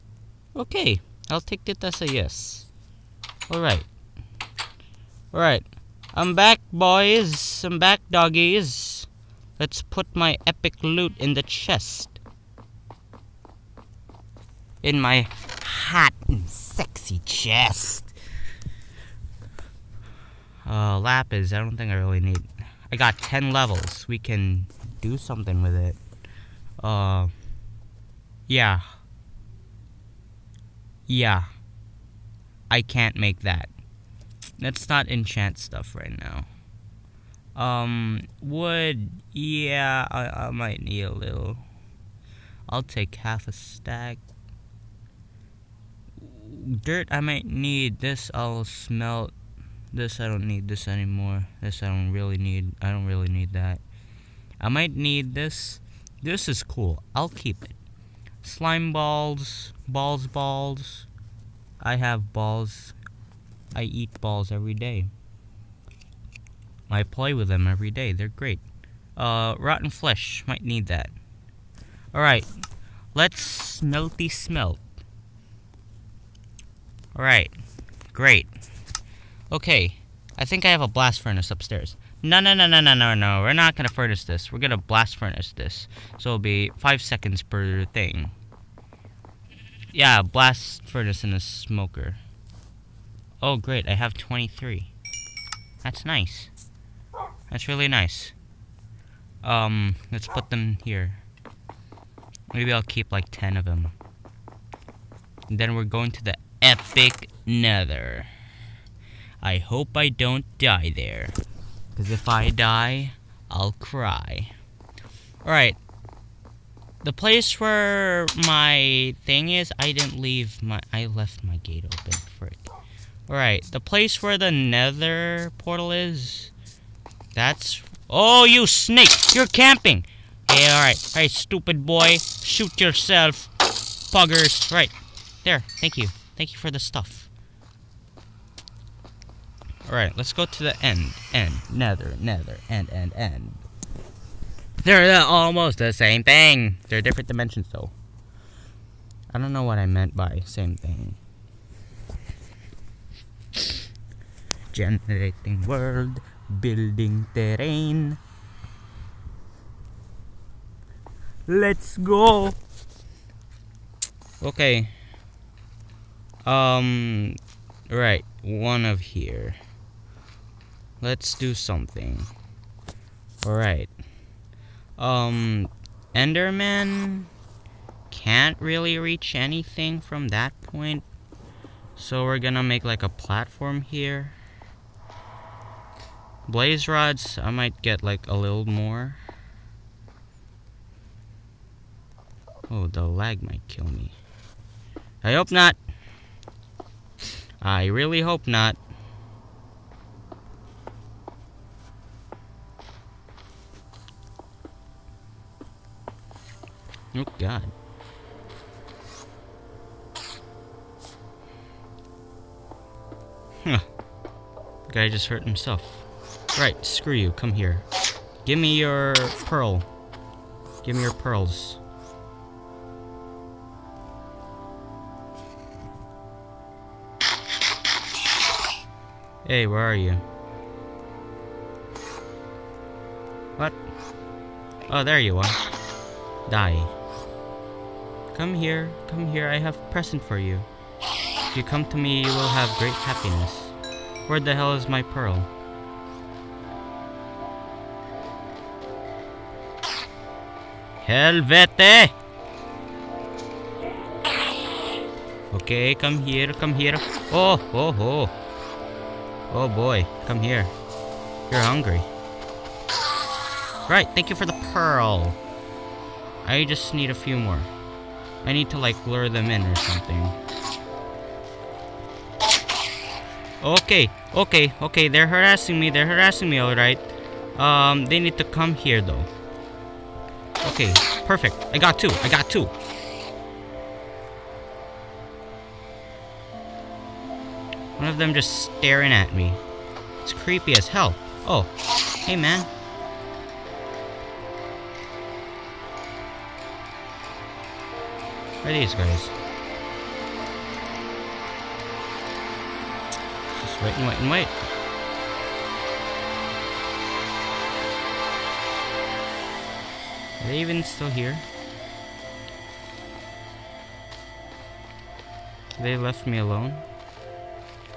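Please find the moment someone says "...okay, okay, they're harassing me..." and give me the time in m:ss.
4:34.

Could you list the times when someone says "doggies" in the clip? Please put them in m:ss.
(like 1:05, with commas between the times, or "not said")
0:08.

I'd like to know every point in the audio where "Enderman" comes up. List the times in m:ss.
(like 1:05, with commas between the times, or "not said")
2:56.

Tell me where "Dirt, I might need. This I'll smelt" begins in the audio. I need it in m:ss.
0:46.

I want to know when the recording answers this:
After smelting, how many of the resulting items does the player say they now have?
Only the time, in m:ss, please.
1:33.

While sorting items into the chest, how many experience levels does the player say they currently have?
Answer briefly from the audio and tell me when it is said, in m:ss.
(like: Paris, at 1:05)
10, at 0:22.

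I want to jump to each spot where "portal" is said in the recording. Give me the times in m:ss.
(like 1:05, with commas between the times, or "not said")
2:05.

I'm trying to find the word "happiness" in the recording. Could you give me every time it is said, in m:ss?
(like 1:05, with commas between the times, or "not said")
4:03.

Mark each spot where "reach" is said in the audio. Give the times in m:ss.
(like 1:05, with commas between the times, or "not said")
2:58.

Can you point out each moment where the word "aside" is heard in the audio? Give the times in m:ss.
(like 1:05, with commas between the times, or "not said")
not said.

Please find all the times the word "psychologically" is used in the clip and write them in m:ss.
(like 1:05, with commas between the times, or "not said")
not said.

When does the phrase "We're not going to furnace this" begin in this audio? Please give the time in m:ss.
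1:23.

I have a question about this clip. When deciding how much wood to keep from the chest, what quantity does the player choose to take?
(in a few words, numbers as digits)
Half a stack.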